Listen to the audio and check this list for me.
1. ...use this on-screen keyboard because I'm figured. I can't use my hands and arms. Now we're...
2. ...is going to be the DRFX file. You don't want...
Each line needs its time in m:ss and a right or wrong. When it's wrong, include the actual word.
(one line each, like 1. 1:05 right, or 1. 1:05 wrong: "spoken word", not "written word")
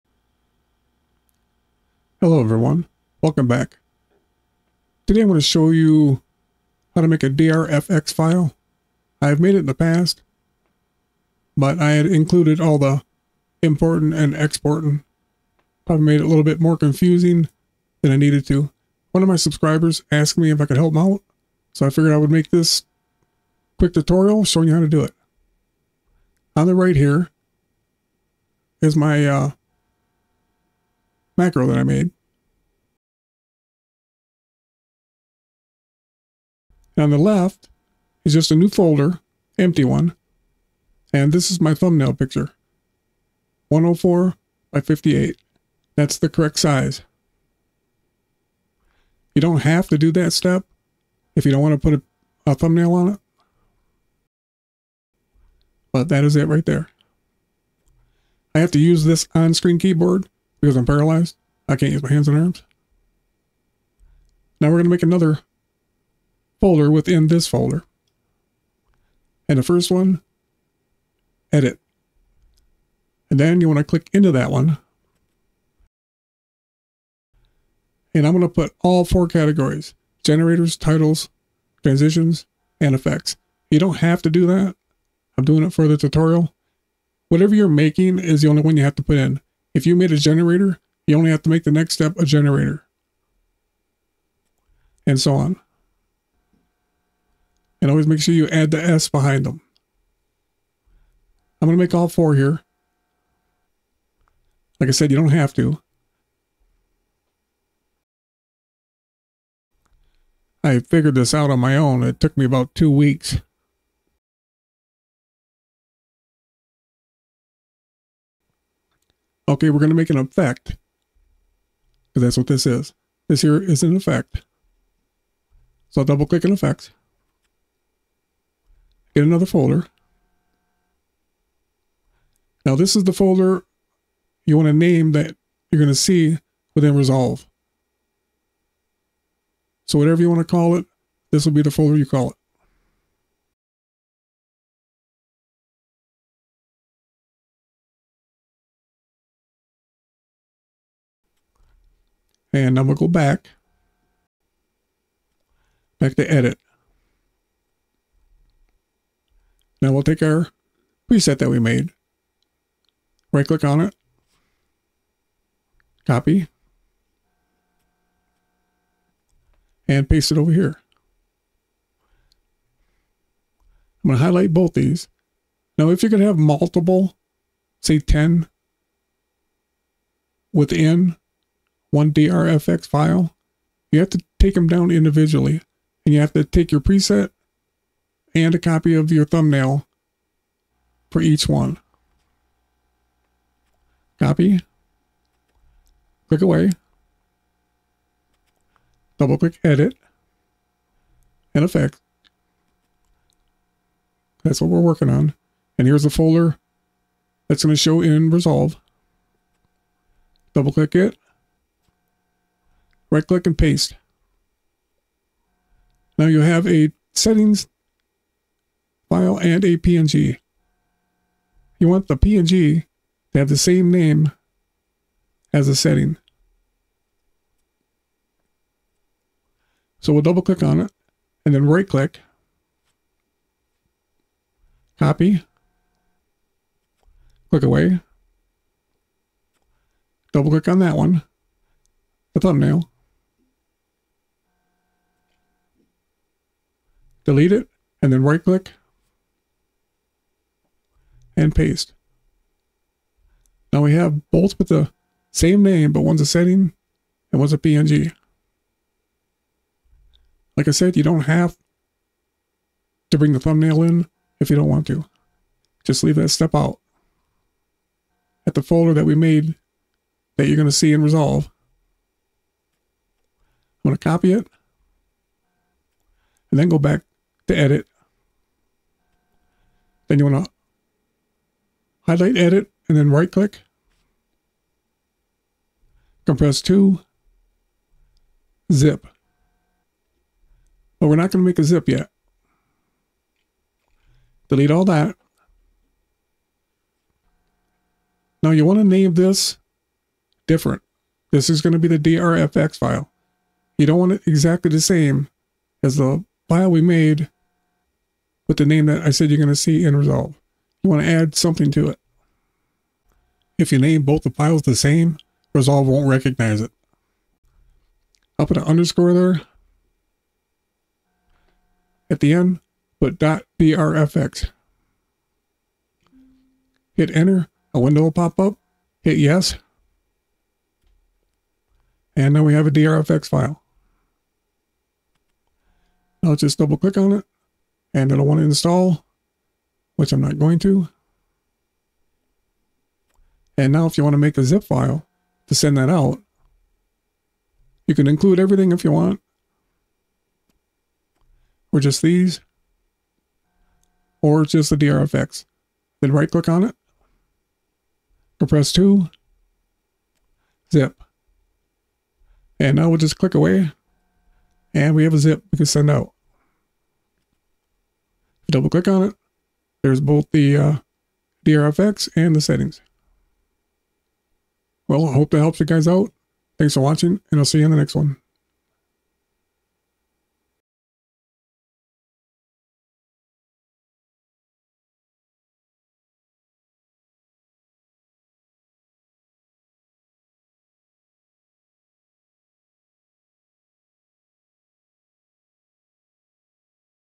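1. 0:58 wrong: "paralyzed", not "figured"
2. 5:01 right.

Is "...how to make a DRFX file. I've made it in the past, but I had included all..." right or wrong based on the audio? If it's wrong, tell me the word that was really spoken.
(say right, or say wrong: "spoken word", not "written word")
right.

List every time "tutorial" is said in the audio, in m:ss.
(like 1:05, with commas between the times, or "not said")
0:23, 1:25.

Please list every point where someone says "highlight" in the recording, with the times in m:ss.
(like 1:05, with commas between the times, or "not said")
2:54, 4:42.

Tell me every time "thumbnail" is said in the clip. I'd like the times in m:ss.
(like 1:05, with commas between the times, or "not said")
0:41, 0:52, 3:09, 4:02, 4:23.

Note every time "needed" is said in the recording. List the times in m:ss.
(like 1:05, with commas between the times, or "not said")
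0:18.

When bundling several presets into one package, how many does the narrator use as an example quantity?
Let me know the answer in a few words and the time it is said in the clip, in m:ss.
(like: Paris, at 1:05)
10, at 2:57.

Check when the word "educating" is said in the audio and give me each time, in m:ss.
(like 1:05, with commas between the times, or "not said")
not said.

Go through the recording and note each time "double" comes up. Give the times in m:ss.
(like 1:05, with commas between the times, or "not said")
2:06, 3:19, 3:30, 3:50, 4:00, 5:36, 6:08.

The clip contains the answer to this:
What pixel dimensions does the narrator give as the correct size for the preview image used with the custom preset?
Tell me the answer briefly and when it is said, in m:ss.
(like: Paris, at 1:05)
104 by 58, at 0:43.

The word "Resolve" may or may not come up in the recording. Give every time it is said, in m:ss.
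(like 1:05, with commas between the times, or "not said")
2:16, 3:28, 4:31, 5:09, 5:15.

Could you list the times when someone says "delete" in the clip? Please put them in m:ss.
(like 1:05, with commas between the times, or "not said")
4:07, 4:54.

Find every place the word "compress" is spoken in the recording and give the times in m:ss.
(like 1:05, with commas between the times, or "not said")
4:46, 5:58.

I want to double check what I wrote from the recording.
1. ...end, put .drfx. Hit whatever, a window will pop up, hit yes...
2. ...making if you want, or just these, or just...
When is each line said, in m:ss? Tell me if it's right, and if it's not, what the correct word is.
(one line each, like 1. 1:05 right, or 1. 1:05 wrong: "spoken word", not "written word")
1. 5:22 wrong: "enter", not "whatever"
2. 5:48 wrong: "everything", not "making".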